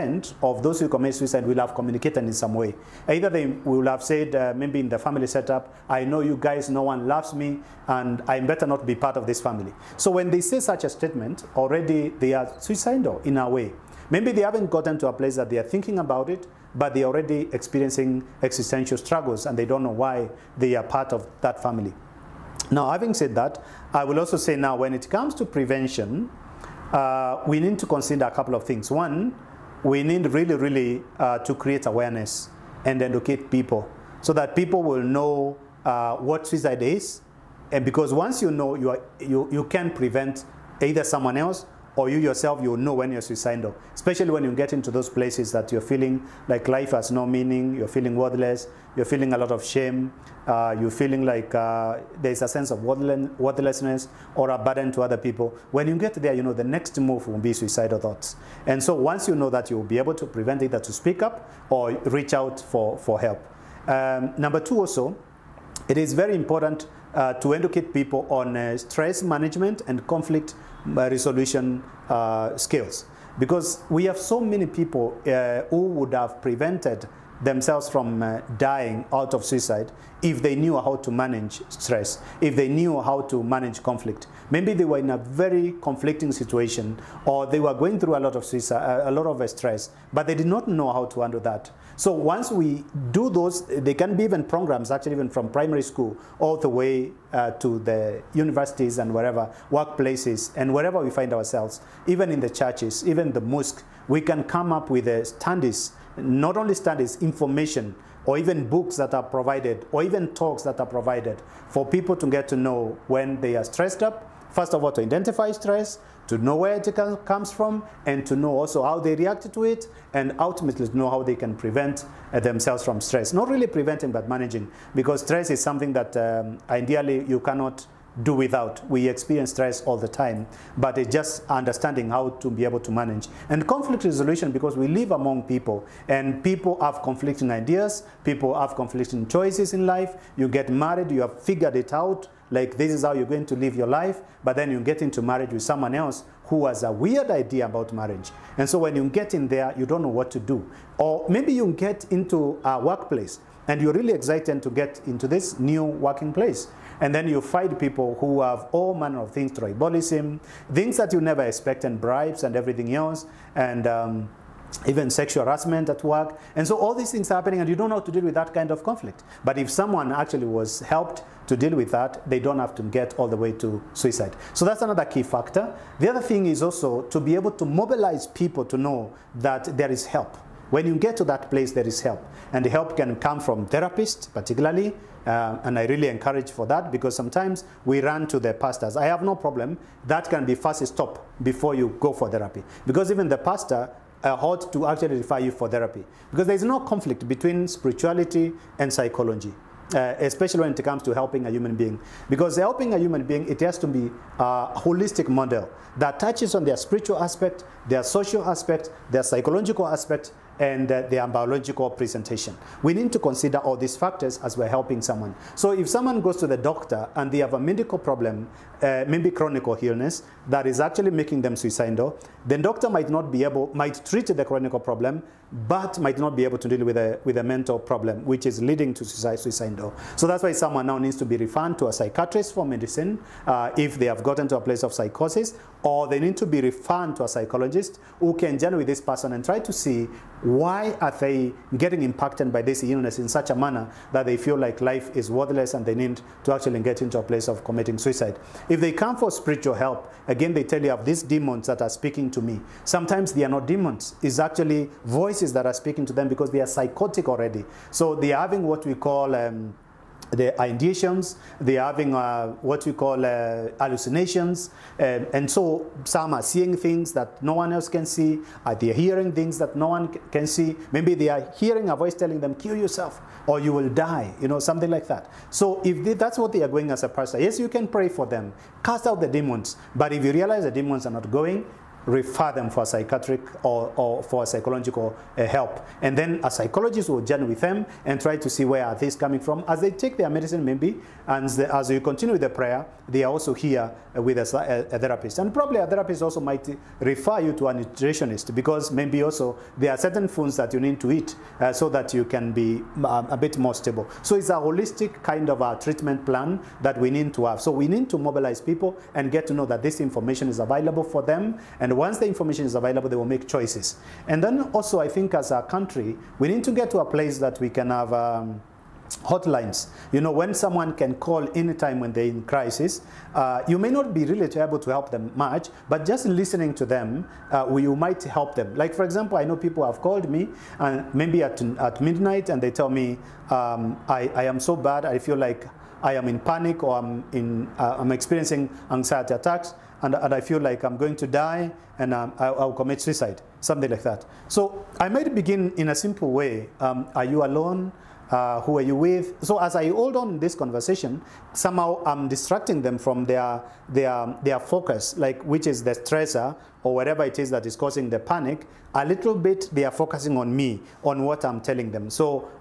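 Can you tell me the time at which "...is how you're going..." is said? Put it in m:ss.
2:22.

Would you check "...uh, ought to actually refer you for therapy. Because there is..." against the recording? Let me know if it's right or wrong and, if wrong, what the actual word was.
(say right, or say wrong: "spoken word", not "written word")
right.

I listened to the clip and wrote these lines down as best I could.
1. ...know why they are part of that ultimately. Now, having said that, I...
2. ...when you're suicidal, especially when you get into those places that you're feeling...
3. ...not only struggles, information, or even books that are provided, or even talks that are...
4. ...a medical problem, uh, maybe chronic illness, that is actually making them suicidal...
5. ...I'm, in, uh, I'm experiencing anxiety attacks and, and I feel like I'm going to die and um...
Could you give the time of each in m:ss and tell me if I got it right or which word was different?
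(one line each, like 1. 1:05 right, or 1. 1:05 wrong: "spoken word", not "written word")
1. 0:19 wrong: "family", not "ultimately"
2. 0:42 right
3. 1:46 wrong: "studies", not "struggles"
4. 3:37 right
5. 5:36 right.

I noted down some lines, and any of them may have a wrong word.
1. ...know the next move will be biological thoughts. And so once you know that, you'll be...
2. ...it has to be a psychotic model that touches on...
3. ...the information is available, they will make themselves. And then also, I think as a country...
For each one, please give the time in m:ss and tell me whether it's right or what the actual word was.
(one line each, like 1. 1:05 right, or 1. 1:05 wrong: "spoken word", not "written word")
1. 0:56 wrong: "suicidal", not "biological"
2. 3:23 wrong: "holistic", not "psychotic"
3. 5:12 wrong: "choices", not "themselves".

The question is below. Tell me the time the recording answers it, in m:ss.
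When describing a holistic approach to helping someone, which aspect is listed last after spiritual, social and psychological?
3:31.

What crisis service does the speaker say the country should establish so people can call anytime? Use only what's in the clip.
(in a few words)
Hotlines.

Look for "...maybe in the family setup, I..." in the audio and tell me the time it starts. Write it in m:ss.
0:04.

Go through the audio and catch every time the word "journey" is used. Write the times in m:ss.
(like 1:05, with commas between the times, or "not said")
4:47.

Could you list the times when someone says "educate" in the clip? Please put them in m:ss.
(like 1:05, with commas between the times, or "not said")
0:33, 1:07.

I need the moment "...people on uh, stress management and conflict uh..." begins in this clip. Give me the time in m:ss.
1:07.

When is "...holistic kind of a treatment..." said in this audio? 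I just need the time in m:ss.
5:04.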